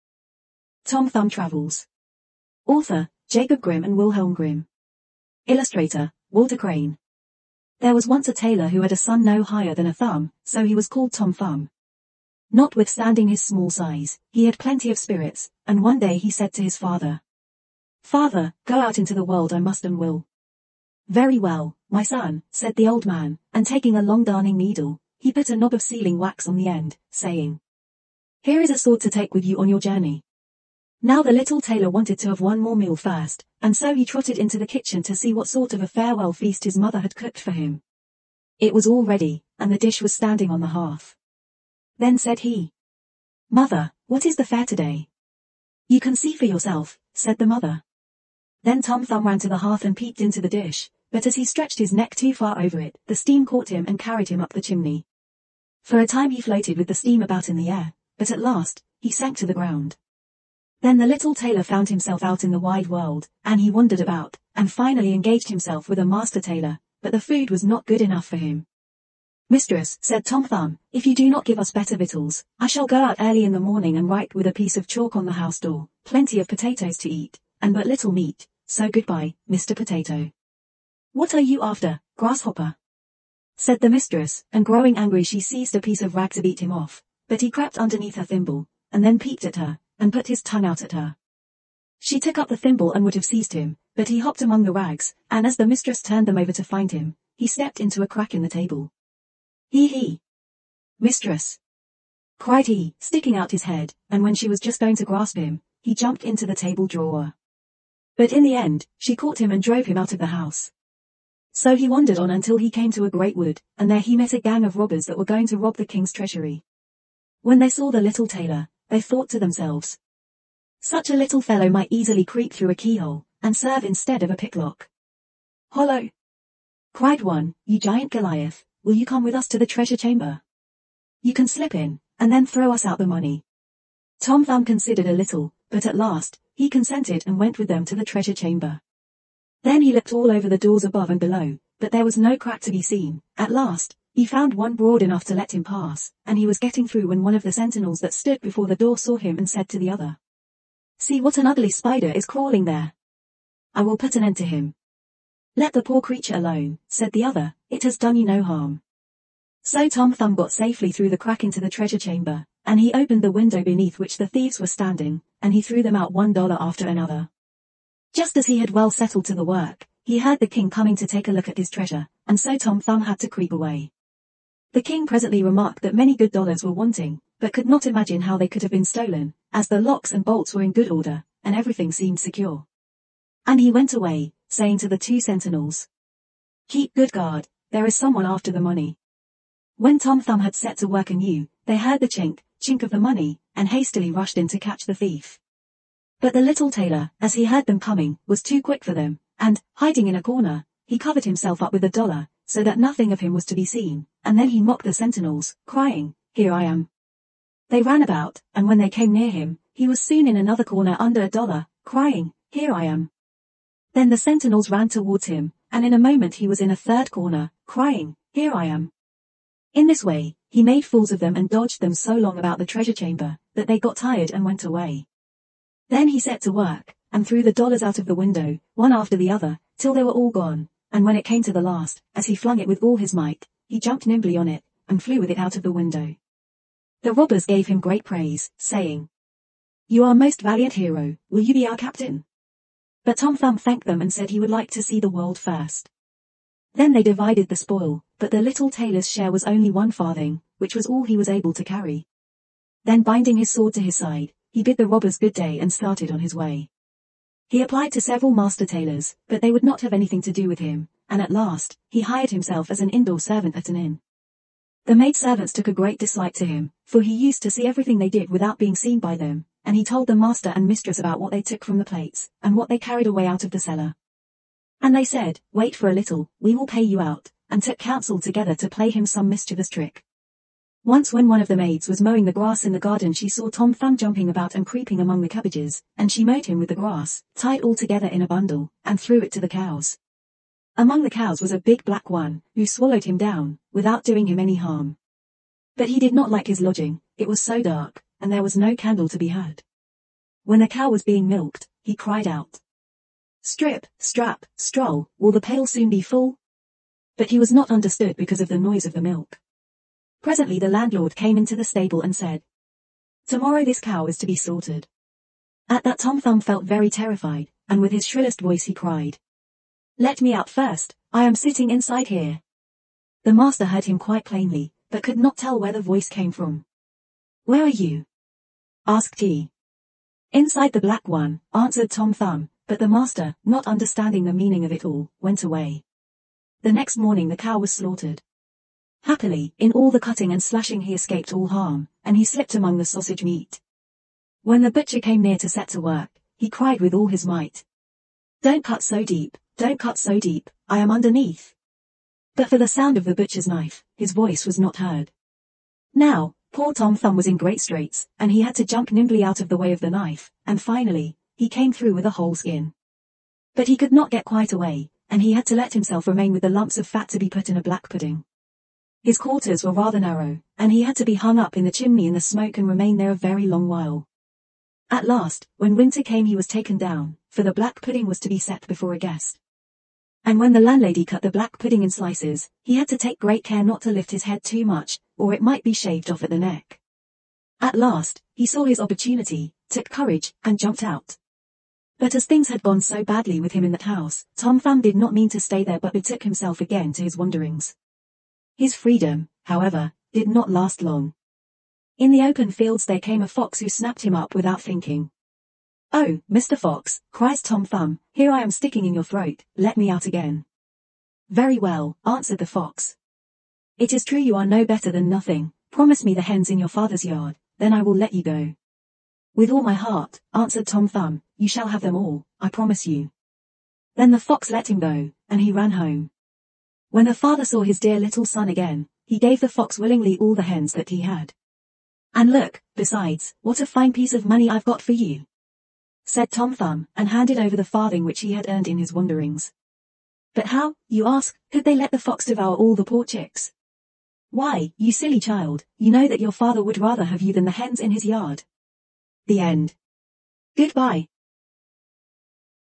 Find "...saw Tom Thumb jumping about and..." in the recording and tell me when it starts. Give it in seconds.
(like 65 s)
283 s.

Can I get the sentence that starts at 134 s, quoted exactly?
Tom Thumb considered a little, but at last, he consented and went with them to the treasure chamber.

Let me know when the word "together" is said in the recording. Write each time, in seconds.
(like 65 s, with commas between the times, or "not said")
278 s, 287 s.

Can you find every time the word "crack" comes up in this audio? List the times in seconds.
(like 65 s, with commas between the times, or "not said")
98 s, 142 s, 161 s.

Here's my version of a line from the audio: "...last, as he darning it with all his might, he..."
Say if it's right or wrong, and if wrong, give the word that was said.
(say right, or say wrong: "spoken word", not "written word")
wrong: "flung", not "darning".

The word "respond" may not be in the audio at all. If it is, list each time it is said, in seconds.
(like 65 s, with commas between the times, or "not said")
not said.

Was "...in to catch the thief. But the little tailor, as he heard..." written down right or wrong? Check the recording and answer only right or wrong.
right.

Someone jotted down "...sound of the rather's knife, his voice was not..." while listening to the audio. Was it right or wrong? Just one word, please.
wrong.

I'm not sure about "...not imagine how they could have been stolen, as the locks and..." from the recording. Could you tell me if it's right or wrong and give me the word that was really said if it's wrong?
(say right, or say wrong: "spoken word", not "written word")
right.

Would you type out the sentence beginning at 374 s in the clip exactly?
At last, when winter came he was taken down, for the black pudding was to be set before a guest.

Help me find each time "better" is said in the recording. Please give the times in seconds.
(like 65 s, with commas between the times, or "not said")
71 s, 414 s.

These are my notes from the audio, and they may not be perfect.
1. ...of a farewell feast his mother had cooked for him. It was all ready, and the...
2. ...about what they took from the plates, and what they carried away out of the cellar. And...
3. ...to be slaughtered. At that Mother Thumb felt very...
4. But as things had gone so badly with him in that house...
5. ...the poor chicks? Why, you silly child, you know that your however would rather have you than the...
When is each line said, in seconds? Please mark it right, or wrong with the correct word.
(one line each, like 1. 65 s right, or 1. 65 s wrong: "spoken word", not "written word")
1. 35 s right
2. 270 s right
3. 314 s wrong: "Tom", not "Mother"
4. 391 s right
5. 442 s wrong: "father", not "however".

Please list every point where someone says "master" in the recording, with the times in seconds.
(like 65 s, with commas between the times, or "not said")
66 s, 258 s, 270 s, 323 s, 332 s.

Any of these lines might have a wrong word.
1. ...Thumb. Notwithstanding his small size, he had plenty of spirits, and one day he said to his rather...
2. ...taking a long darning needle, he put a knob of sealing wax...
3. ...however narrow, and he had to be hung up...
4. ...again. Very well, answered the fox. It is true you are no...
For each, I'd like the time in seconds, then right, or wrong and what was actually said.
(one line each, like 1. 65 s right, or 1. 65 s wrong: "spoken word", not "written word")
1. 11 s wrong: "father", not "rather"
2. 23 s right
3. 369 s wrong: "rather", not "however"
4. 410 s right.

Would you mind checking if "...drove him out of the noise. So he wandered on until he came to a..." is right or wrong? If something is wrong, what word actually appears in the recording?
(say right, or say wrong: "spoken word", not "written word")
wrong: "house", not "noise".